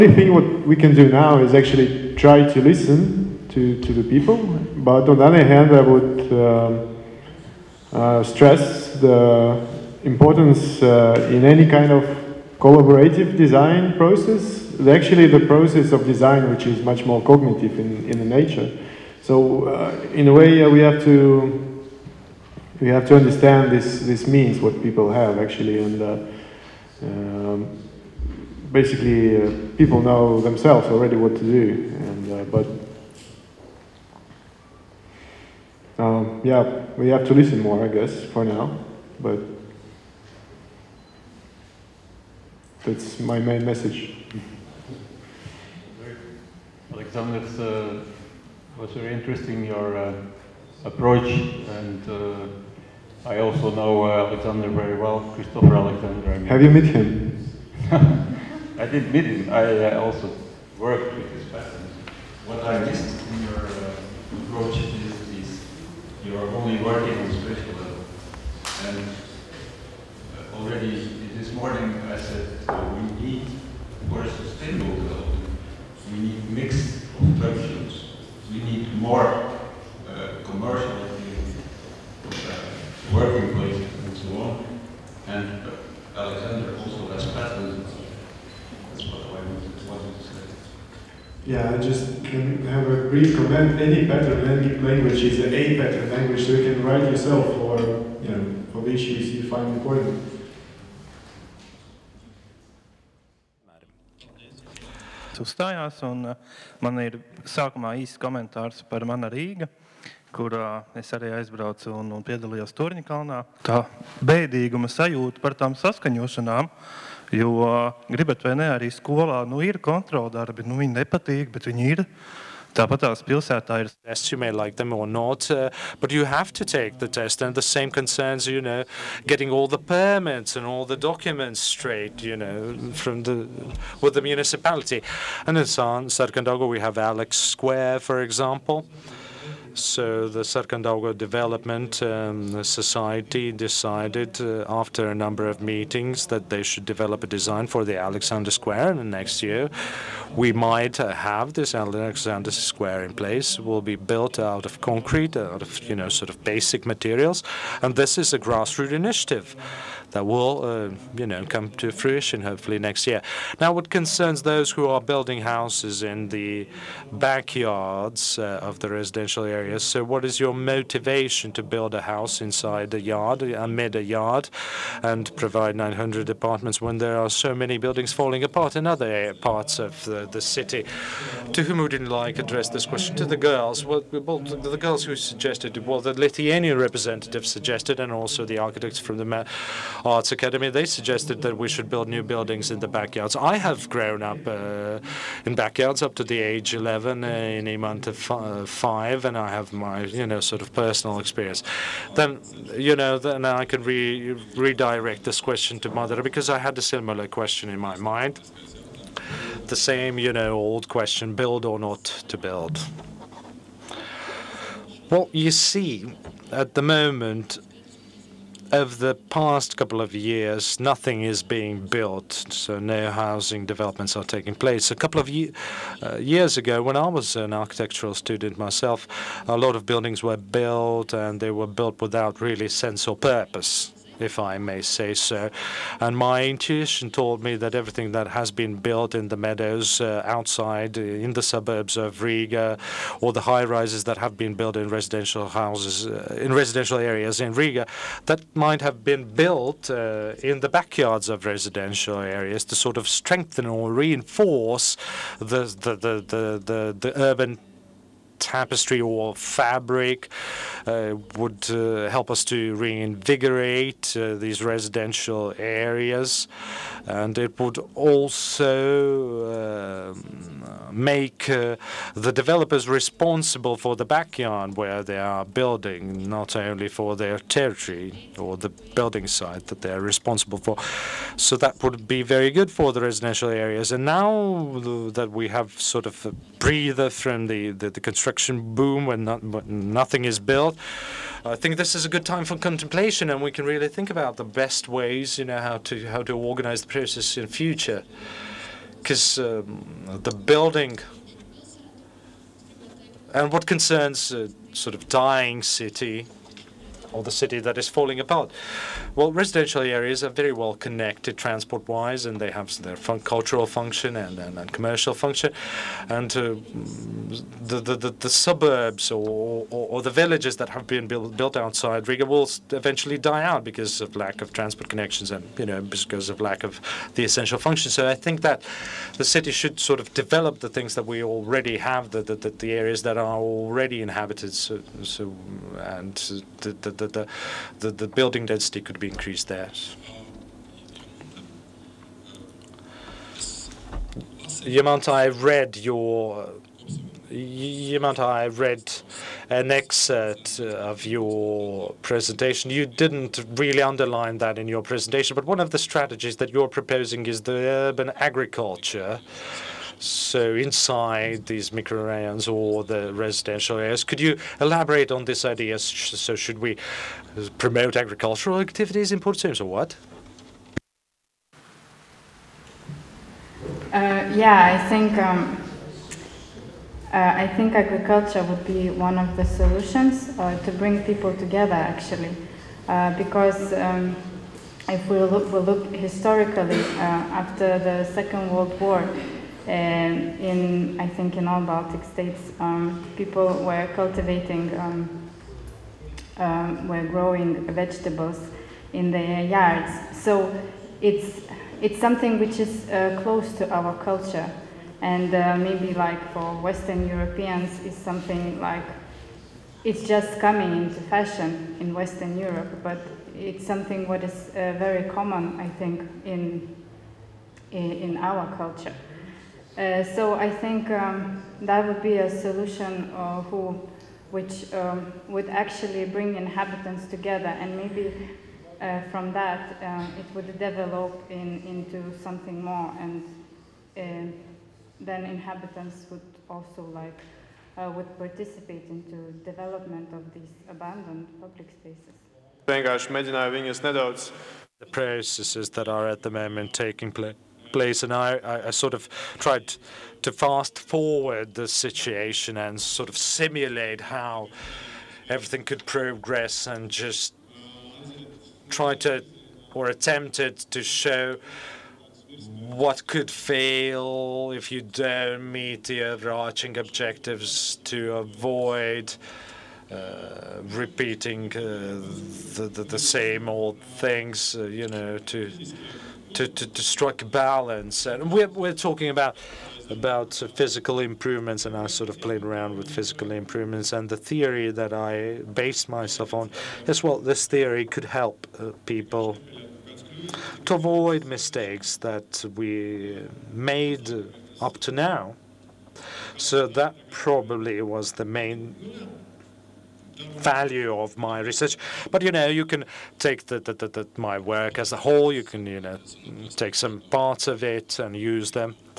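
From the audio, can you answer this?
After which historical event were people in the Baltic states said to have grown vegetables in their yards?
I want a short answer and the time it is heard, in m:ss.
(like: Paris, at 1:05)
Second World War, at 6:28.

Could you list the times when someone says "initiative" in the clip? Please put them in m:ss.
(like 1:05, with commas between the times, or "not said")
2:38.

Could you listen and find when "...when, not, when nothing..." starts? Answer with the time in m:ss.
4:49.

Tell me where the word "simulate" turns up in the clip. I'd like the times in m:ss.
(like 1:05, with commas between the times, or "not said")
7:33.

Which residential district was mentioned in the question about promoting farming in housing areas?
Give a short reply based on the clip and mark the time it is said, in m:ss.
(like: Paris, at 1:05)
Purvciems, at 6:09.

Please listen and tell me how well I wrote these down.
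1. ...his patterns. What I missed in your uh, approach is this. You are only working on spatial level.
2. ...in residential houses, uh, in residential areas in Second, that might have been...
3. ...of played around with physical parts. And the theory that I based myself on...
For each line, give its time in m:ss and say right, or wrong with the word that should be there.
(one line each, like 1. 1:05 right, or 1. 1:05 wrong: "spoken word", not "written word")
1. 1:01 right
2. 4:04 wrong: "Riga", not "Second"
3. 8:02 wrong: "improvements", not "parts".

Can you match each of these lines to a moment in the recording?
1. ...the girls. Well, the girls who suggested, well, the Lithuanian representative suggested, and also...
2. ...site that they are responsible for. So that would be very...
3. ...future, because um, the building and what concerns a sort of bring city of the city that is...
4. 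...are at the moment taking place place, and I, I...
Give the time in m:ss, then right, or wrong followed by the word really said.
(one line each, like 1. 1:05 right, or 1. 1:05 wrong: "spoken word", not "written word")
1. 3:03 right
2. 4:39 right
3. 4:57 wrong: "dying", not "bring"
4. 7:25 right.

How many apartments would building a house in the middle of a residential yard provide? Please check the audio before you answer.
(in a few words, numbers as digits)
900.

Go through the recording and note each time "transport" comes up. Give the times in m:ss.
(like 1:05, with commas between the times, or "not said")
5:11, 5:24.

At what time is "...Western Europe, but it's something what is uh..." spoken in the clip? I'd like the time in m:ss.
6:51.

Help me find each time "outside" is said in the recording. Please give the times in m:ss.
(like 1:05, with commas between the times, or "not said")
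4:00, 5:21.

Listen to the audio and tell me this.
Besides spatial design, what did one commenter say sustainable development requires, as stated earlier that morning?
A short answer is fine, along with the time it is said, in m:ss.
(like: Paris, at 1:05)
mix of functions, at 1:16.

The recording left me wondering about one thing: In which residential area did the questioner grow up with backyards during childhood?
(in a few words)
Imanta.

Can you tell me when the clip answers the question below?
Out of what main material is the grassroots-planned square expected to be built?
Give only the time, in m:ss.
2:34.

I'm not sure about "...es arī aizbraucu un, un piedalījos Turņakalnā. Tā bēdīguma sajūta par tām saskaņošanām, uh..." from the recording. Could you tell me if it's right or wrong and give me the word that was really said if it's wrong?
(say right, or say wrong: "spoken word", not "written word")
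right.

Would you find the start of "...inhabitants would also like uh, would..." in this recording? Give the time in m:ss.
7:15.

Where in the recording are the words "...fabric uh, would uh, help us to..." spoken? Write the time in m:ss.
4:19.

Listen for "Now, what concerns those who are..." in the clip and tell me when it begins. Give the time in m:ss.
2:43.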